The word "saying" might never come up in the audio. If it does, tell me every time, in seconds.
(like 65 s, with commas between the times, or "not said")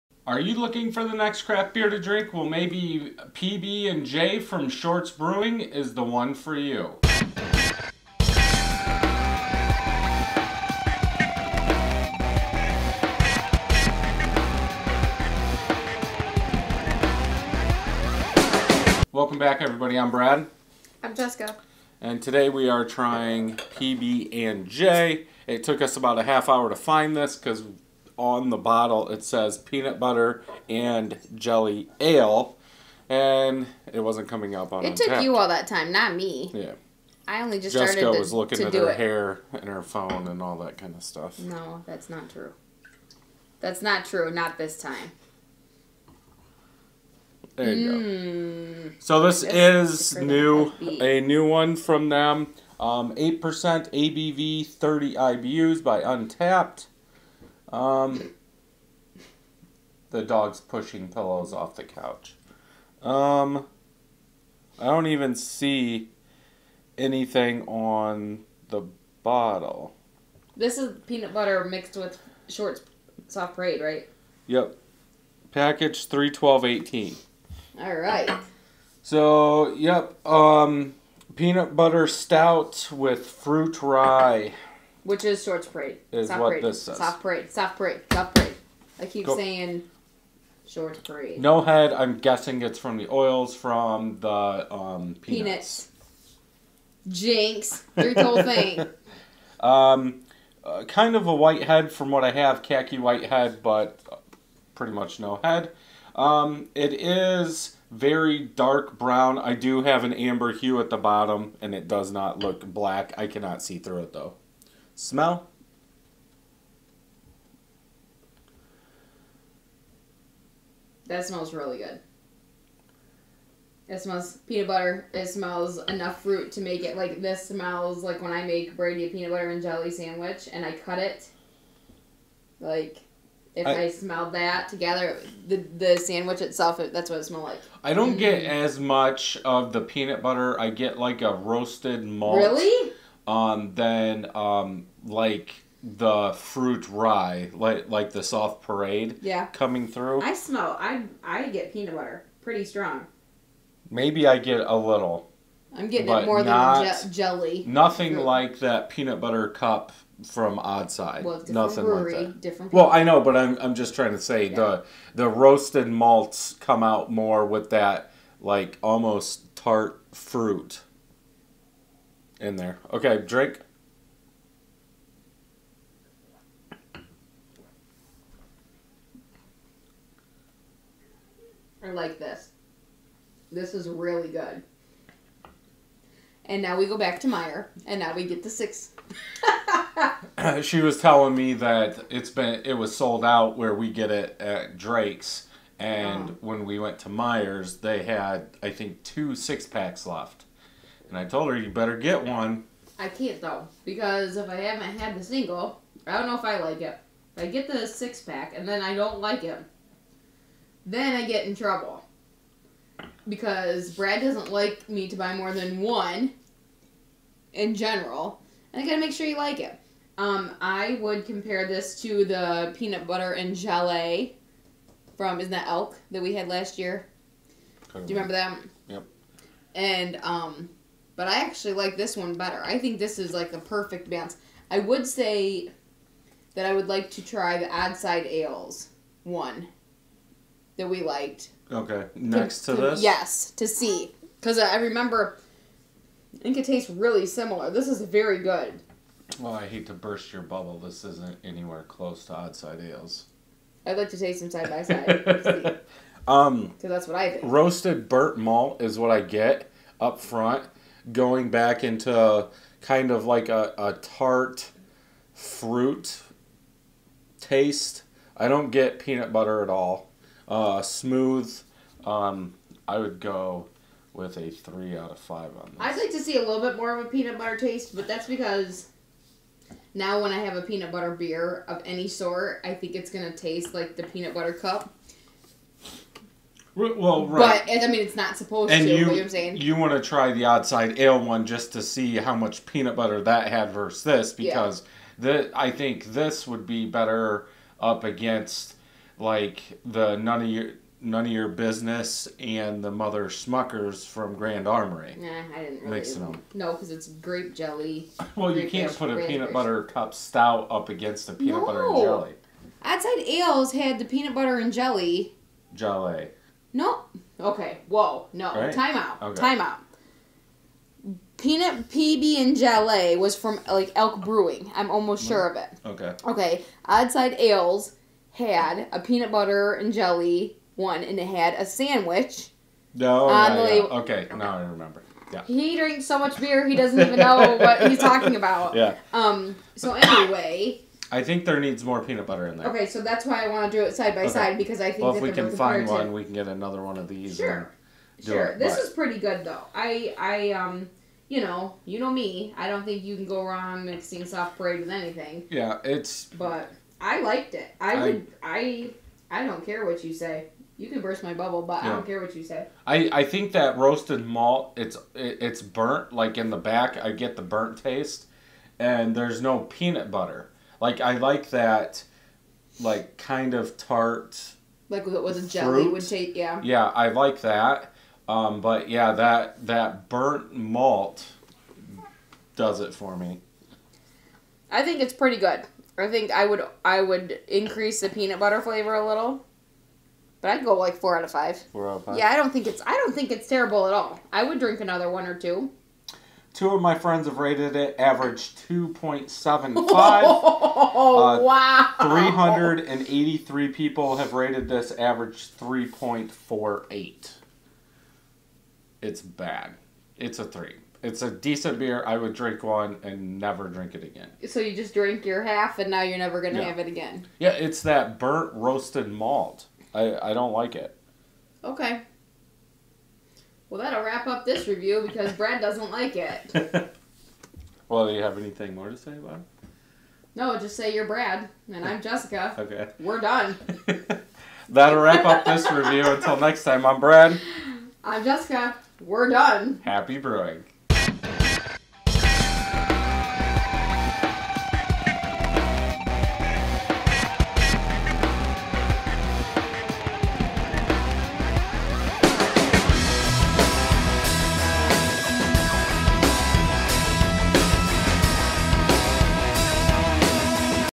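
89 s, 289 s.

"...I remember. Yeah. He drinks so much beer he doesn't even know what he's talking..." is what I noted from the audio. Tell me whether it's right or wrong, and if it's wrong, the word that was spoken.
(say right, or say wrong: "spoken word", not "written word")
right.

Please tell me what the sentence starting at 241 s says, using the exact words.
Okay, next to, to, to this?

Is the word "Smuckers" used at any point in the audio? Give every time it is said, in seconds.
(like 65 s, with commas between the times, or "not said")
303 s.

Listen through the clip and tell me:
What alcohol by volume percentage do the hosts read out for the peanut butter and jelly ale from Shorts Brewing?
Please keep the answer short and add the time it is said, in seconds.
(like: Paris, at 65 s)
8%, at 53 s.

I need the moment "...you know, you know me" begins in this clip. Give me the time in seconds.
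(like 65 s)
351 s.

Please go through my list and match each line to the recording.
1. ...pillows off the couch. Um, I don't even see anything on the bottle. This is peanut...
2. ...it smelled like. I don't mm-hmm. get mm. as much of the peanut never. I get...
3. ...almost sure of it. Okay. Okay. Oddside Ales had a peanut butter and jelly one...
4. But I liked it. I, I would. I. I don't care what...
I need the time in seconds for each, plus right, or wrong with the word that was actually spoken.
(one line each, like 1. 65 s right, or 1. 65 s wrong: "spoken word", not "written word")
1. 61 s right
2. 137 s wrong: "butter", not "never"
3. 324 s right
4. 356 s right.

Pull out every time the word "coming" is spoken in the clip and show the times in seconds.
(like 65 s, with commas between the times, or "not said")
34 s, 149 s.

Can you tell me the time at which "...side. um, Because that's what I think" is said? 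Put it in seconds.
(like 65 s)
254 s.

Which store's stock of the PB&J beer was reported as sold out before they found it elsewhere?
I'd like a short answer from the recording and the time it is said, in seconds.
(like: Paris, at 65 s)
Drake's, at 194 s.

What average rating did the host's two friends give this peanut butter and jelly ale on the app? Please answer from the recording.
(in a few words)
2.75.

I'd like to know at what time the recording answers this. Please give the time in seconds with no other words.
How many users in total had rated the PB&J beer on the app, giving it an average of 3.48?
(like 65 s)
402 s.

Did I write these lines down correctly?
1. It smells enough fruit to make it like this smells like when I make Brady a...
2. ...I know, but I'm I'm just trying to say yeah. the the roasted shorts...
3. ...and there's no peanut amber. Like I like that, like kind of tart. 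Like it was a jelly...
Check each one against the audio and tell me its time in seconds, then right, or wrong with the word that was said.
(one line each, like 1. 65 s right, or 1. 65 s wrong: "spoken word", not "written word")
1. 125 s right
2. 162 s wrong: "malts", not "shorts"
3. 368 s wrong: "butter", not "amber".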